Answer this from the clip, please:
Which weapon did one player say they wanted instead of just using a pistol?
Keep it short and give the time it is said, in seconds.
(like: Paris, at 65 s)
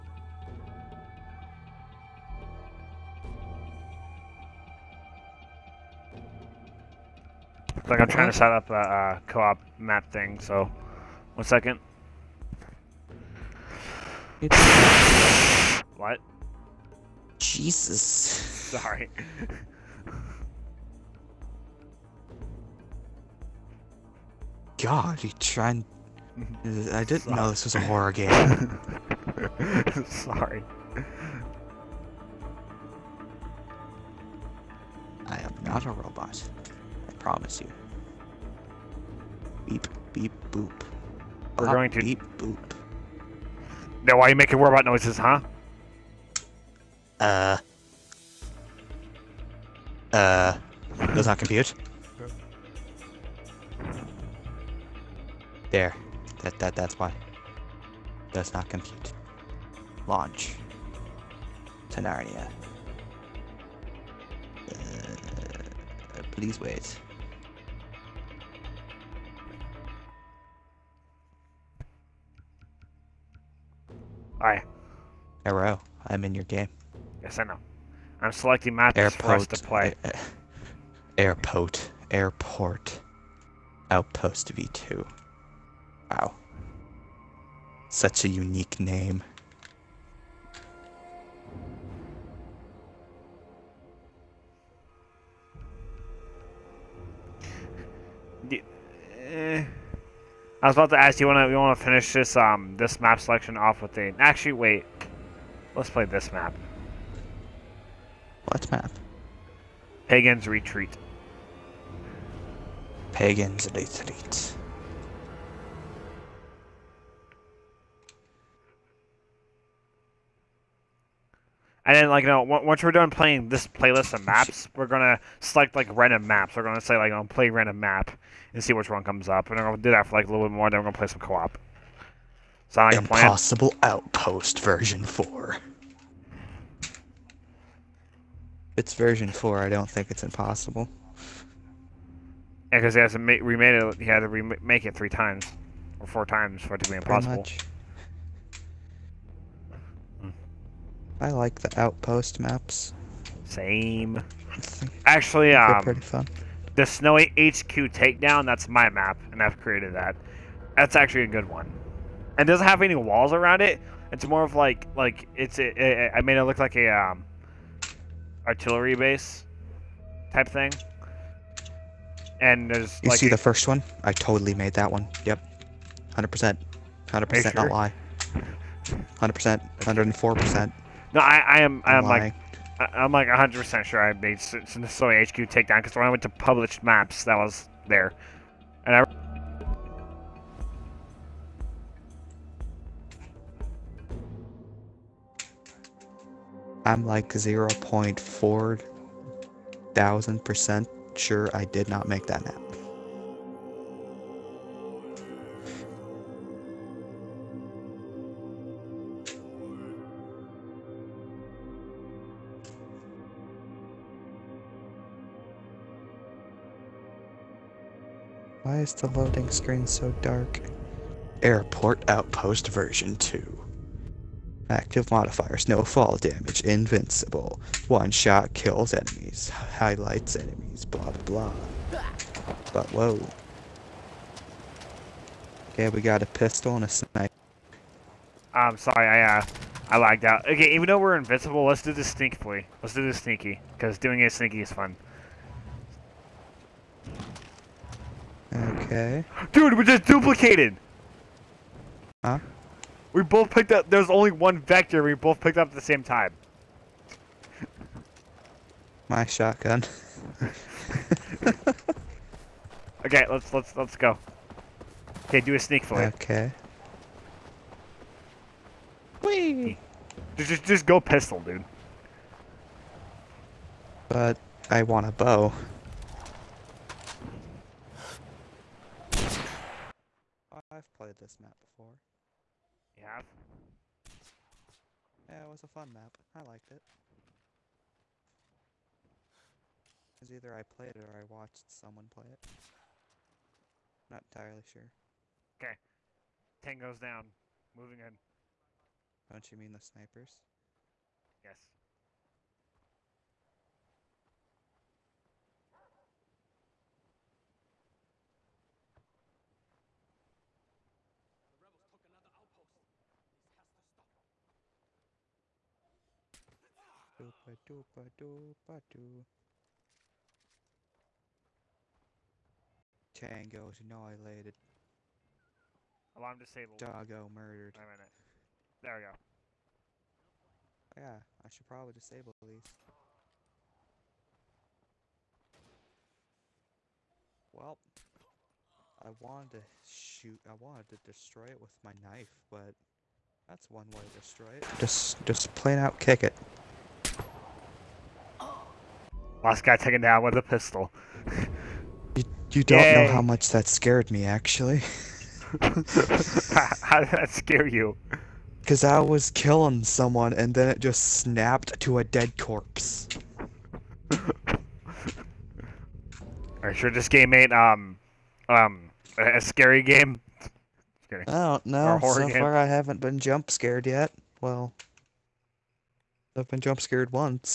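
bow, at 275 s.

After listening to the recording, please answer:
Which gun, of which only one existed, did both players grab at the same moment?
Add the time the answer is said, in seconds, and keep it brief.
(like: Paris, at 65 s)
vector, at 254 s.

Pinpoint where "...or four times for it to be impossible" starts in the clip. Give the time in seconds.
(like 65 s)
146 s.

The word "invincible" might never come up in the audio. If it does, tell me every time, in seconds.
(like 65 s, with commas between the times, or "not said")
226 s, 241 s.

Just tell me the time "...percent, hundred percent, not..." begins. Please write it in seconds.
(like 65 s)
176 s.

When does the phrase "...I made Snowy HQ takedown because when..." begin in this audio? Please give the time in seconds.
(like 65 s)
184 s.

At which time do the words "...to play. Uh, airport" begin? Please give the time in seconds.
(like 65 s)
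79 s.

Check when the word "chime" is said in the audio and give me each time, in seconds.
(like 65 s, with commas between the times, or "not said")
not said.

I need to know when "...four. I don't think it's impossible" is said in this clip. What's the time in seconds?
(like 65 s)
139 s.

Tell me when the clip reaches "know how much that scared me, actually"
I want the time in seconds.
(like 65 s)
353 s.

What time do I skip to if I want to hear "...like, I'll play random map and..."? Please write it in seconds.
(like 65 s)
126 s.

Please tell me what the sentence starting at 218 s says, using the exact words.
Why is the loading screen so dark?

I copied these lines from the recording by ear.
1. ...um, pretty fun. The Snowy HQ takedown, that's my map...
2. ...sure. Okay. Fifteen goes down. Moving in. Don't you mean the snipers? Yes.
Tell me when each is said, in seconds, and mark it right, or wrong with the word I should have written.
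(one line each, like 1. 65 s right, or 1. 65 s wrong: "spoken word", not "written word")
1. 155 s right
2. 294 s wrong: "Ten", not "Fifteen".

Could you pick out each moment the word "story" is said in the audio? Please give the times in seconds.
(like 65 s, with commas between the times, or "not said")
not said.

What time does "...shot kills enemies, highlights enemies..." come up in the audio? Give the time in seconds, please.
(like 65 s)
228 s.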